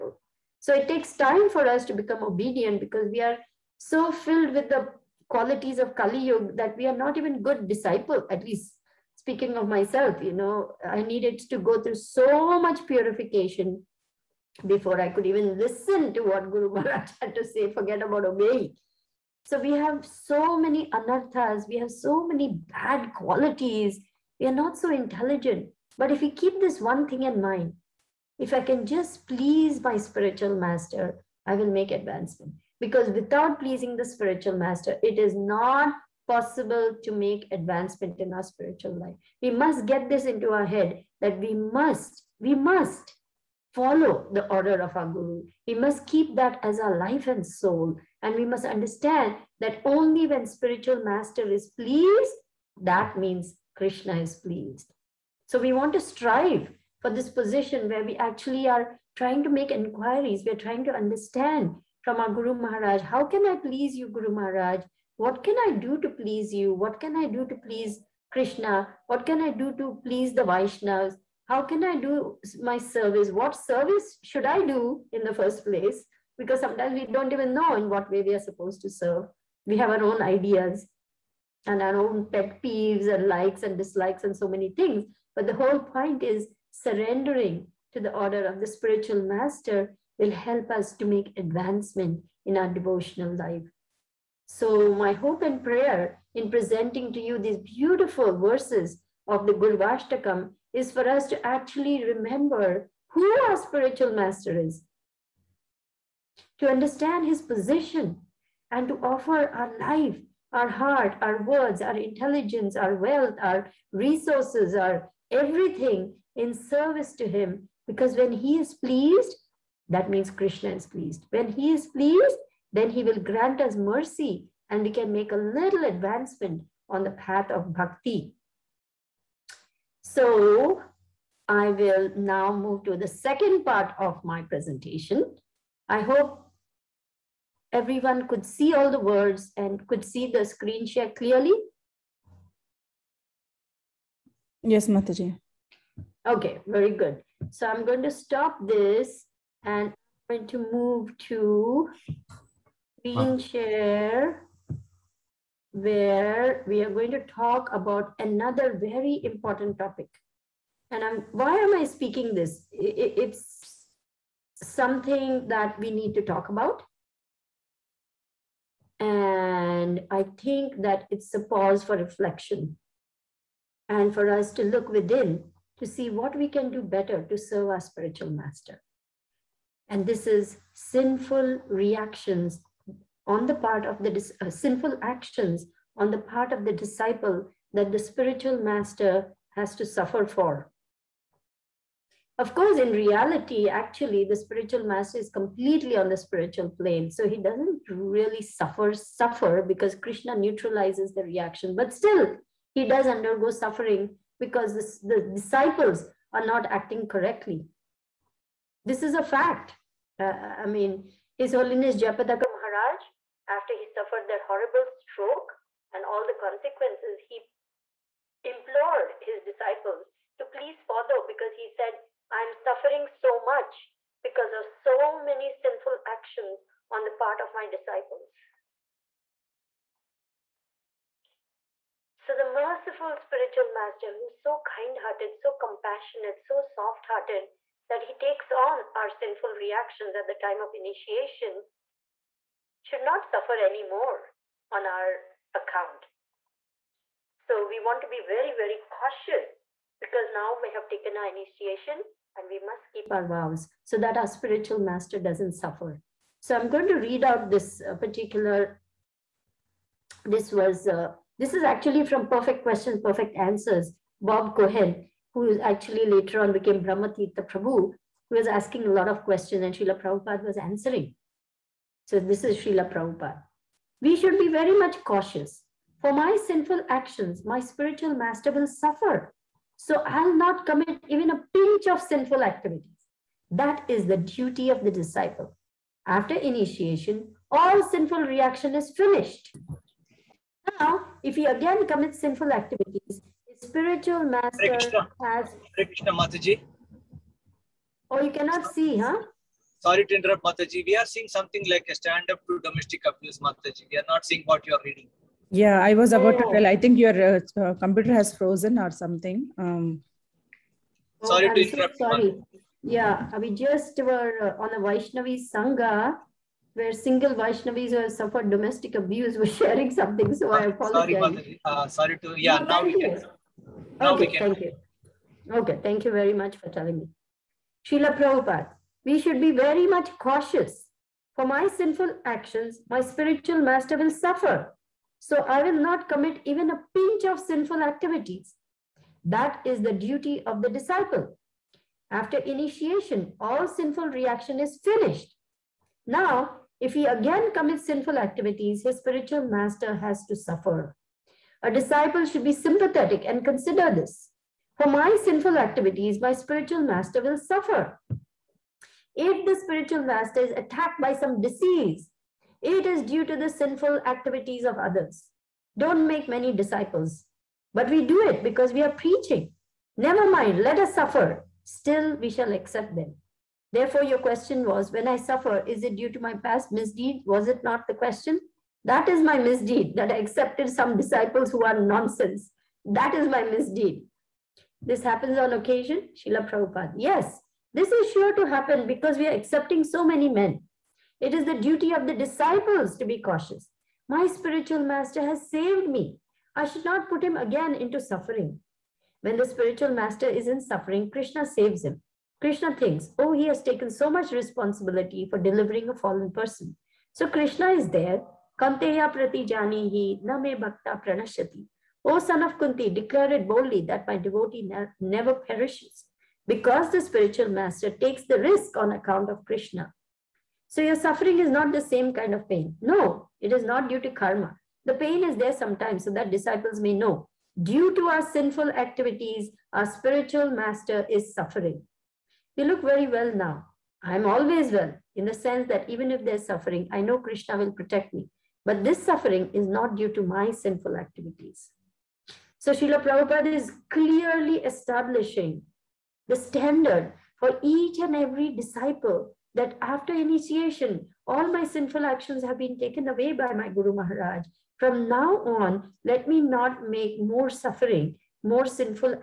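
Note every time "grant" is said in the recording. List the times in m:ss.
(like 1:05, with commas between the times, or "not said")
2:03.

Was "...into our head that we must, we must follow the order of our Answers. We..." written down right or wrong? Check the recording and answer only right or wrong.
wrong.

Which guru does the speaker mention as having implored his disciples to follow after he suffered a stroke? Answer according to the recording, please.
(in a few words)
Jayapataka Maharaj.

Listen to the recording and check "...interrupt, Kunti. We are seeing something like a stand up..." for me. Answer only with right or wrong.
wrong.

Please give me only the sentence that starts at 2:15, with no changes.
I hope everyone could see all the words and could see the screen share clearly.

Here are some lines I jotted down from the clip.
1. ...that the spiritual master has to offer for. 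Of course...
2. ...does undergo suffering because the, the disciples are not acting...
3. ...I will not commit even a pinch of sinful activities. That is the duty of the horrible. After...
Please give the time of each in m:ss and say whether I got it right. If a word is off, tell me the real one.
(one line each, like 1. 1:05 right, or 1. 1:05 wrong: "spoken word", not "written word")
1. 3:07 wrong: "suffer", not "offer"
2. 3:22 right
3. 5:35 wrong: "disciple", not "horrible".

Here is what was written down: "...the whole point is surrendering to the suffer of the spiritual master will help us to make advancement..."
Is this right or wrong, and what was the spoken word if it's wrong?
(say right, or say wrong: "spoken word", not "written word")
wrong: "order", not "suffer".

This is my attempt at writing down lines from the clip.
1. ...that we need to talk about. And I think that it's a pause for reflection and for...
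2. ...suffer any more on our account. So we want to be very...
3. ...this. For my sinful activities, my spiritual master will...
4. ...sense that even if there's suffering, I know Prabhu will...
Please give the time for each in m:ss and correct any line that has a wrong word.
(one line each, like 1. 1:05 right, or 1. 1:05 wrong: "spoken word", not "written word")
1. 2:45 right
2. 4:03 right
3. 5:53 right
4. 7:15 wrong: "Krishna", not "Prabhu".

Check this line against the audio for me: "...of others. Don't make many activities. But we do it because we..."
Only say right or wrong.
wrong.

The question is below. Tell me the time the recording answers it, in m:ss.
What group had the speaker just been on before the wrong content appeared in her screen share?
5:14.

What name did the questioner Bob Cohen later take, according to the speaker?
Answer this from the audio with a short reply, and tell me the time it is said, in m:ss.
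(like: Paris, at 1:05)
Brahmatirtha Prabhu, at 4:26.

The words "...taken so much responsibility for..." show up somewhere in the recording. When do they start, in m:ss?
6:43.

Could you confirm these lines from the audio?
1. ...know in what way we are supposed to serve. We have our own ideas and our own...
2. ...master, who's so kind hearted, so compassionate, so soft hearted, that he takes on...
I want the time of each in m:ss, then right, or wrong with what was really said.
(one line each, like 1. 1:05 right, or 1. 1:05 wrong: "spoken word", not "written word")
1. 1:17 right
2. 3:53 right.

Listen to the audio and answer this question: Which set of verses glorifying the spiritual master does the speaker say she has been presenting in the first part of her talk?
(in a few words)
Gurvashtakam.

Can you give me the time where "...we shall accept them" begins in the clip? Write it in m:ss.
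6:12.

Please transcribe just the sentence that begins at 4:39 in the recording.
So I'll not commit even a pinch of sinful activities.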